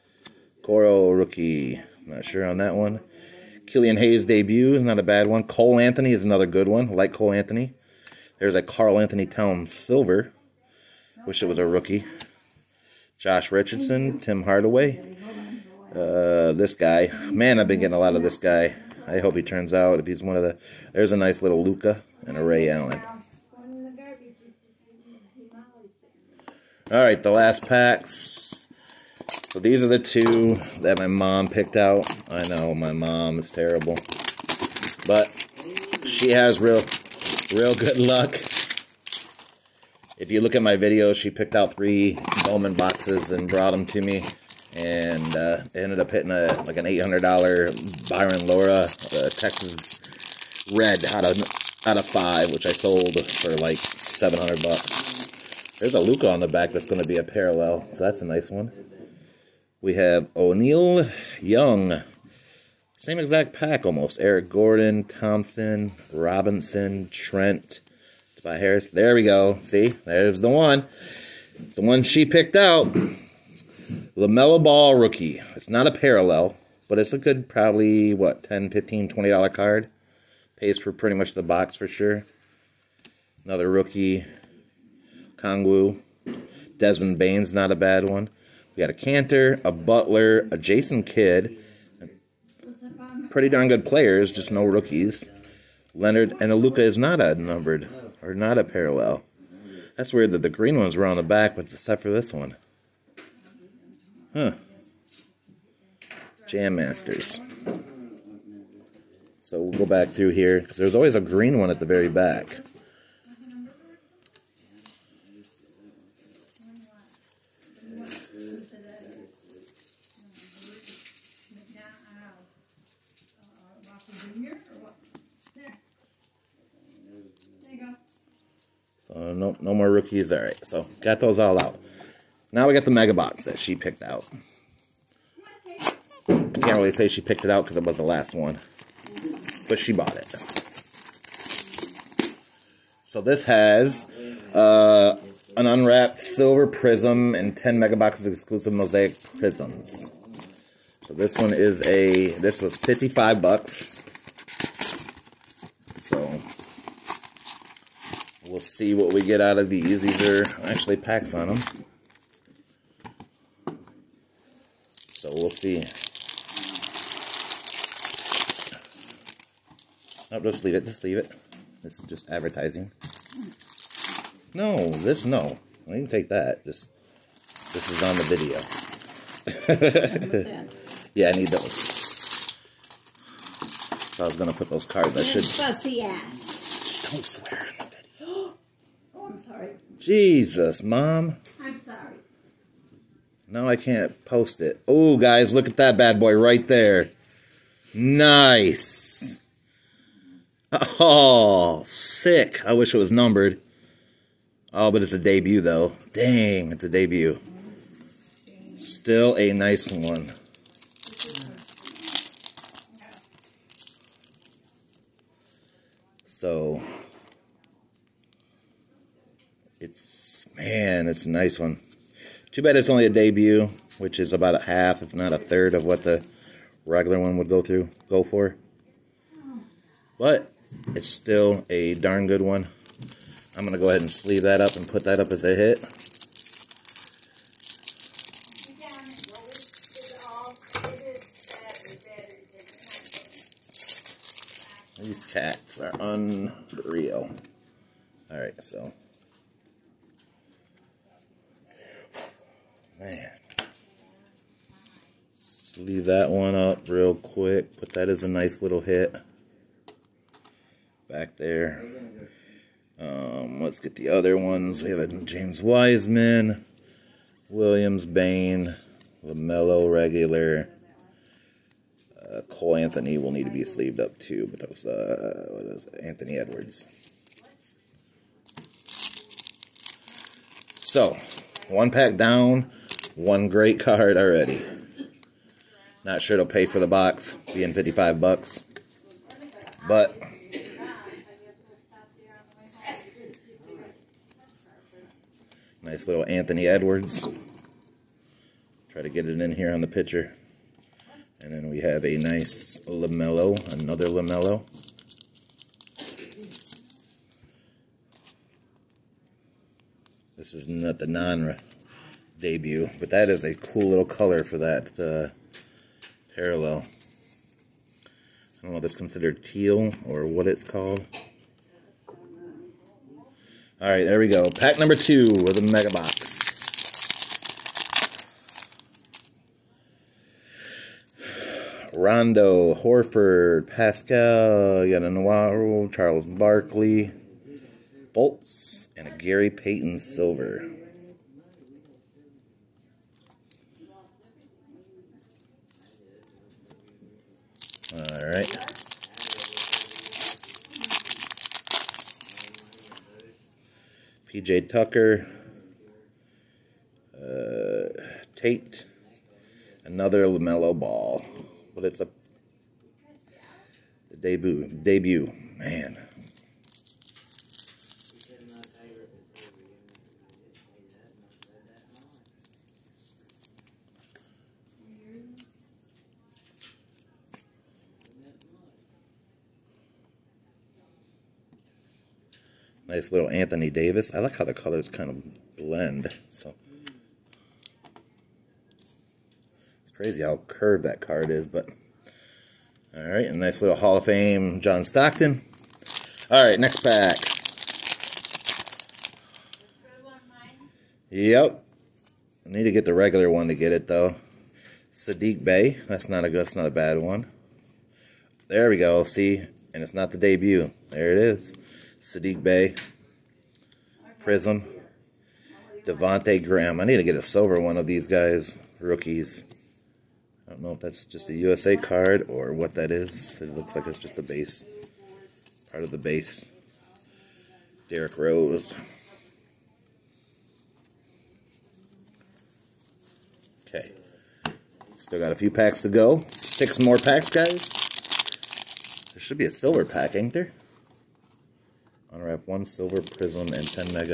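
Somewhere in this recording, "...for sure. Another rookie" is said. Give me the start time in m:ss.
1:21.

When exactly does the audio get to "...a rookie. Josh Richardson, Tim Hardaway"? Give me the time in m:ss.
0:11.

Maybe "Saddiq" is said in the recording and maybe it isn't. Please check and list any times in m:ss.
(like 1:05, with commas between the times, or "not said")
6:44, 6:52.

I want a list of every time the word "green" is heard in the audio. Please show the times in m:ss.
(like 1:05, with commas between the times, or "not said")
1:40, 1:51.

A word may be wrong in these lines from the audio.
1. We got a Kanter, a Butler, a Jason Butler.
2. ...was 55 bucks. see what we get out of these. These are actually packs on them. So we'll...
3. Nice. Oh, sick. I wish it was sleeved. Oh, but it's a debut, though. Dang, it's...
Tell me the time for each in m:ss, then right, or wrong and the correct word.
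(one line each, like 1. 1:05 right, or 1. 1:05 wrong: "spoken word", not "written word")
1. 1:28 wrong: "Kidd", not "Butler"
2. 2:32 right
3. 3:17 wrong: "numbered", not "sleeved".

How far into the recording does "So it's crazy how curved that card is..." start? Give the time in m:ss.
6:26.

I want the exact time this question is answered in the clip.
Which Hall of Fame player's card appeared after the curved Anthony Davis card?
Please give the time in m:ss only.
6:34.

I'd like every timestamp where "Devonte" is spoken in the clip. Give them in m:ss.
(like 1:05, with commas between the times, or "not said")
6:55.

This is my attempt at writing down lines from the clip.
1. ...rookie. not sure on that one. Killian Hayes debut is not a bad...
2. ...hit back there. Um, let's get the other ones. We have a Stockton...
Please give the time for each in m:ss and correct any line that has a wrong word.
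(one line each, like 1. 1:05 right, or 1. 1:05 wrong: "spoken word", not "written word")
1. 0:01 right
2. 4:18 wrong: "James", not "Stockton".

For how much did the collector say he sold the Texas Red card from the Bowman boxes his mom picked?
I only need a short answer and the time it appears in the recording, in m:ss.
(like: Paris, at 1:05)
$700, at 0:53.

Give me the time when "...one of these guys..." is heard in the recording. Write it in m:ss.
6:57.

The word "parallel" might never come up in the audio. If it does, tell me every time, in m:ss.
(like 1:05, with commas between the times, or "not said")
0:57, 1:15, 1:38, 5:16.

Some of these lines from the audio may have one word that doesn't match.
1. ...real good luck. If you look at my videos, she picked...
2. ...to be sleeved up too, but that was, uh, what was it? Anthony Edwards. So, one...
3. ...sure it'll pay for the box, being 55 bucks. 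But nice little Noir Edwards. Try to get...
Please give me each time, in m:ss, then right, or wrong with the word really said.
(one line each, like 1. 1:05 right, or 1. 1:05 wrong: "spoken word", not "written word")
1. 0:37 right
2. 4:33 right
3. 4:46 wrong: "Anthony", not "Noir".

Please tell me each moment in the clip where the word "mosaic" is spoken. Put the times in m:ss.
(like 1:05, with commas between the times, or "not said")
2:28.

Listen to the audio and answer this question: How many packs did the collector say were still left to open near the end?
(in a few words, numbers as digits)
6.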